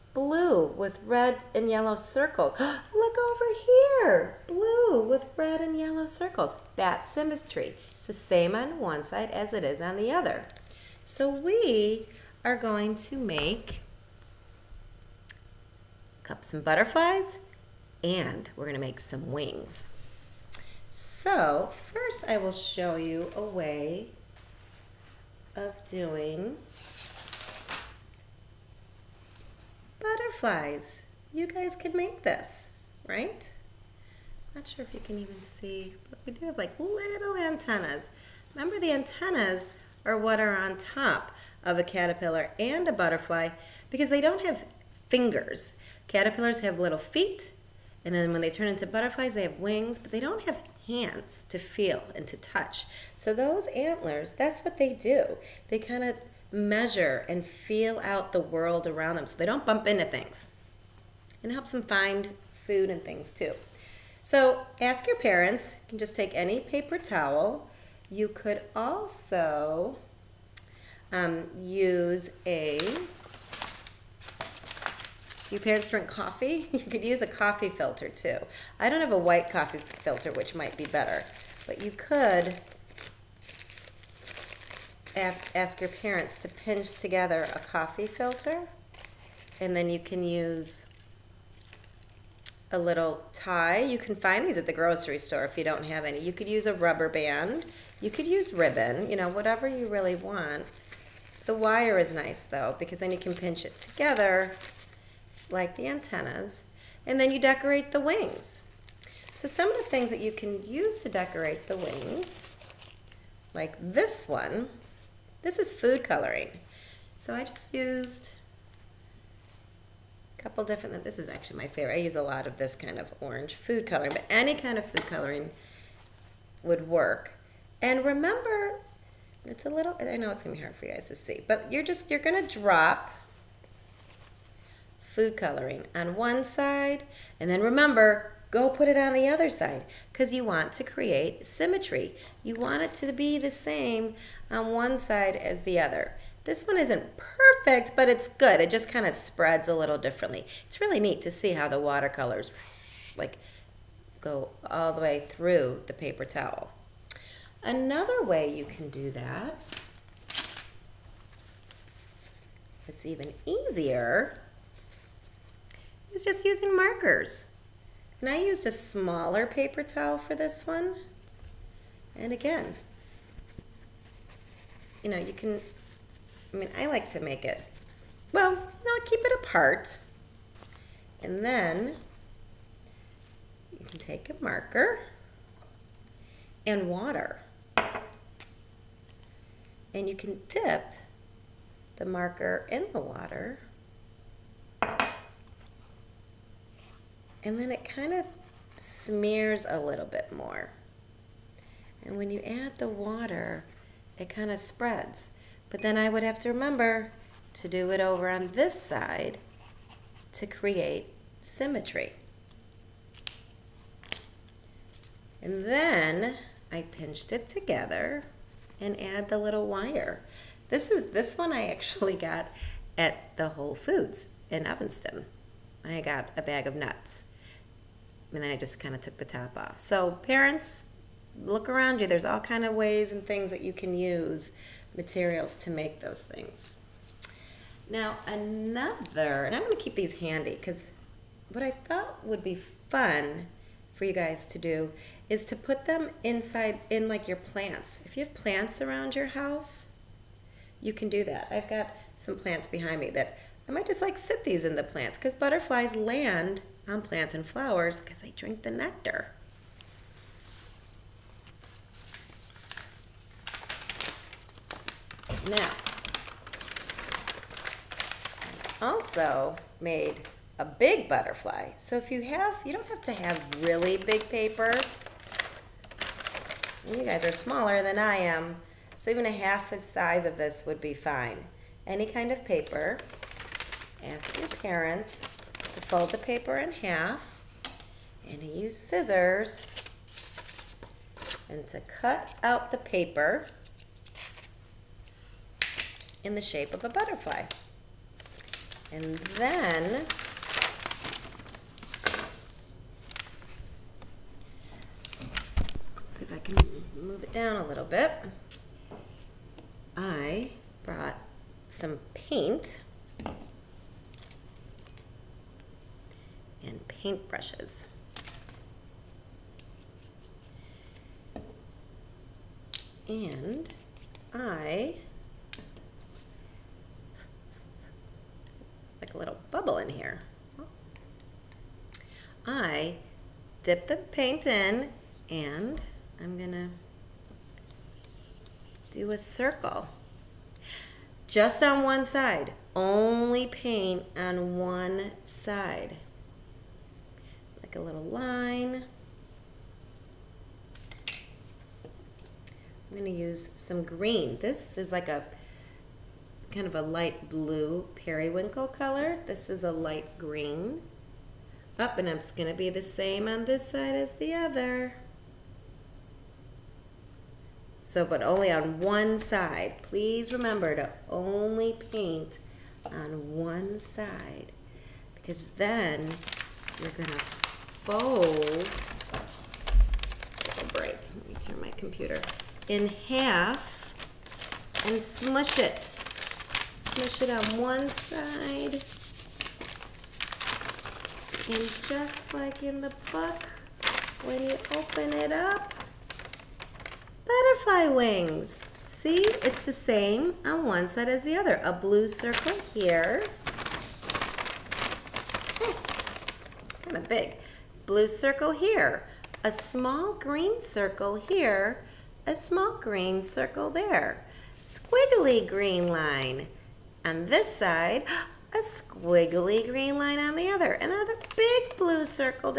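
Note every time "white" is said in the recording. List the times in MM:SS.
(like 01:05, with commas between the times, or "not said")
01:19.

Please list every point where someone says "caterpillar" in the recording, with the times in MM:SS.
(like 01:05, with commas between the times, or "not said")
00:41, 00:46.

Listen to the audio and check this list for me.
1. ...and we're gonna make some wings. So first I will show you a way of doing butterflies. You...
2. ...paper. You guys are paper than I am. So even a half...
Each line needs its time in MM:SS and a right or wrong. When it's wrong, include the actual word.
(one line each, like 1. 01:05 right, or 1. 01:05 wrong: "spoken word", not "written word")
1. 00:18 right
2. 04:34 wrong: "smaller", not "paper".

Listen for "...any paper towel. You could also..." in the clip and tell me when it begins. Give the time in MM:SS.
01:06.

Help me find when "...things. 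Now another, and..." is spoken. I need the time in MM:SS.
03:56.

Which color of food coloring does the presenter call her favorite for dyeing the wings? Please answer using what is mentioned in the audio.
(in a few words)
Orange.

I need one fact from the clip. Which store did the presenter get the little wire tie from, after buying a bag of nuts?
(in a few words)
Whole Foods.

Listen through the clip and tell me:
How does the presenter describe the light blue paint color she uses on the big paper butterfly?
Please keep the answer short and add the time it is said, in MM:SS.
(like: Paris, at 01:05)
Periwinkle, at 05:57.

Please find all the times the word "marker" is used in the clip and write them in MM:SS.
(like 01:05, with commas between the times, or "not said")
02:46, 03:04, 03:12.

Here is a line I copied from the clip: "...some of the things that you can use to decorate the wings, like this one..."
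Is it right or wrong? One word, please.
right.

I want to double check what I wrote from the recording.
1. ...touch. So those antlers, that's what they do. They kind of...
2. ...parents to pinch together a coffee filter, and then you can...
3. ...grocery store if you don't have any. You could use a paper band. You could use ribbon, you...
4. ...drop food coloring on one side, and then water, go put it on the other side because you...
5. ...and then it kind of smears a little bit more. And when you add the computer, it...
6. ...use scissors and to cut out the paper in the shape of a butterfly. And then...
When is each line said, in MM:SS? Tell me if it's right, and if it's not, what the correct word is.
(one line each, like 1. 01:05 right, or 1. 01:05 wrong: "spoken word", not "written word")
1. 00:52 right
2. 01:25 right
3. 01:34 wrong: "rubber", not "paper"
4. 02:12 wrong: "remember", not "water"
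5. 03:17 wrong: "water", not "computer"
6. 04:48 right.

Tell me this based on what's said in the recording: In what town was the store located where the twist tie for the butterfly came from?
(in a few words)
Evanston.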